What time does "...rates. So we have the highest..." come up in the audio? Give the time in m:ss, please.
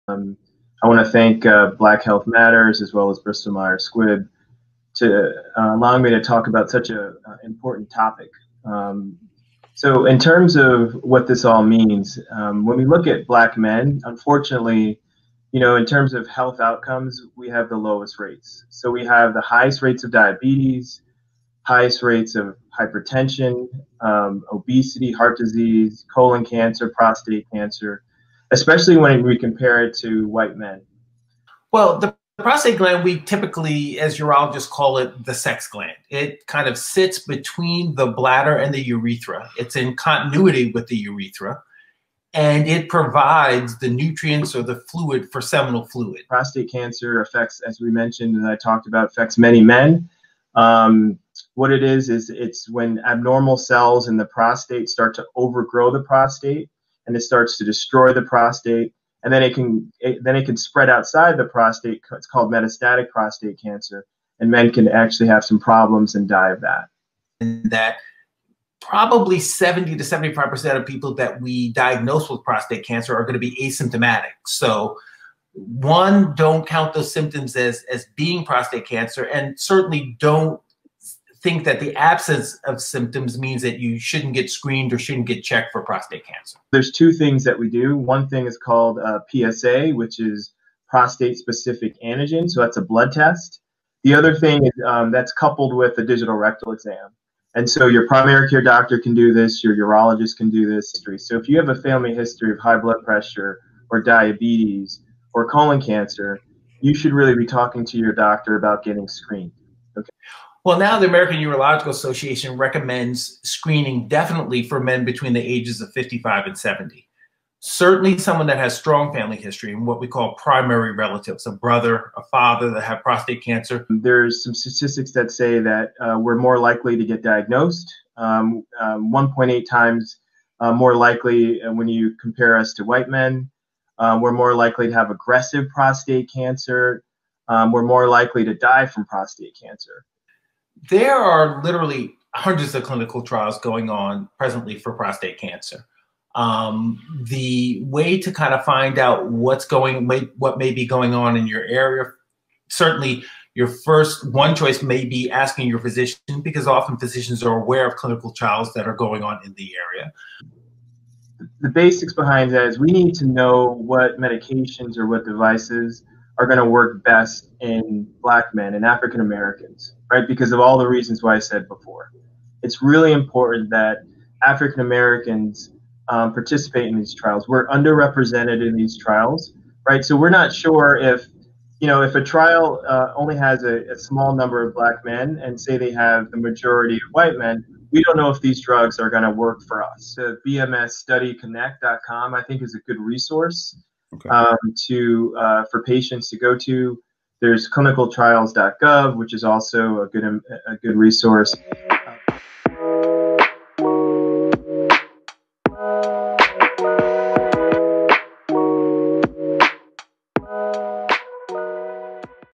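0:18.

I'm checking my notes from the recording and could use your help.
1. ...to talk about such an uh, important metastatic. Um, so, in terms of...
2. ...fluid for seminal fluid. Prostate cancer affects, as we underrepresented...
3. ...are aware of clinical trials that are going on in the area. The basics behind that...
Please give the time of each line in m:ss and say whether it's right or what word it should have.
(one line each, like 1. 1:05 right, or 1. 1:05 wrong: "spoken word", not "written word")
1. 0:06 wrong: "topic", not "metastatic"
2. 0:44 wrong: "mentioned", not "underrepresented"
3. 2:37 right.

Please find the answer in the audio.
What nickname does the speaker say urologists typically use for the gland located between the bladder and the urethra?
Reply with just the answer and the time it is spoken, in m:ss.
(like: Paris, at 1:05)
sex gland, at 0:35.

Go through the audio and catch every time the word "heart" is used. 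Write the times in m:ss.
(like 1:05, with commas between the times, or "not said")
0:25.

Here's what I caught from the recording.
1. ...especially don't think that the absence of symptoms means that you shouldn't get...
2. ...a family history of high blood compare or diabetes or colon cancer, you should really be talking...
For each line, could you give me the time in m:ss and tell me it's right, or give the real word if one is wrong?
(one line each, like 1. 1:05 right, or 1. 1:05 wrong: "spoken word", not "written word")
1. 1:19 wrong: "certainly", not "especially"
2. 1:41 wrong: "pressure", not "compare".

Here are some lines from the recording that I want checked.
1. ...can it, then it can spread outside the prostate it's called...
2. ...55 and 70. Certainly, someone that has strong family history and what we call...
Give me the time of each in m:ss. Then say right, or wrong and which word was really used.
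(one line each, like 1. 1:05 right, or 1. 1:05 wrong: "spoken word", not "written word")
1. 0:59 right
2. 1:55 right.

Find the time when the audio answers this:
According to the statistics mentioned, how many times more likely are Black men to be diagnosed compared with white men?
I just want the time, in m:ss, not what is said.
2:09.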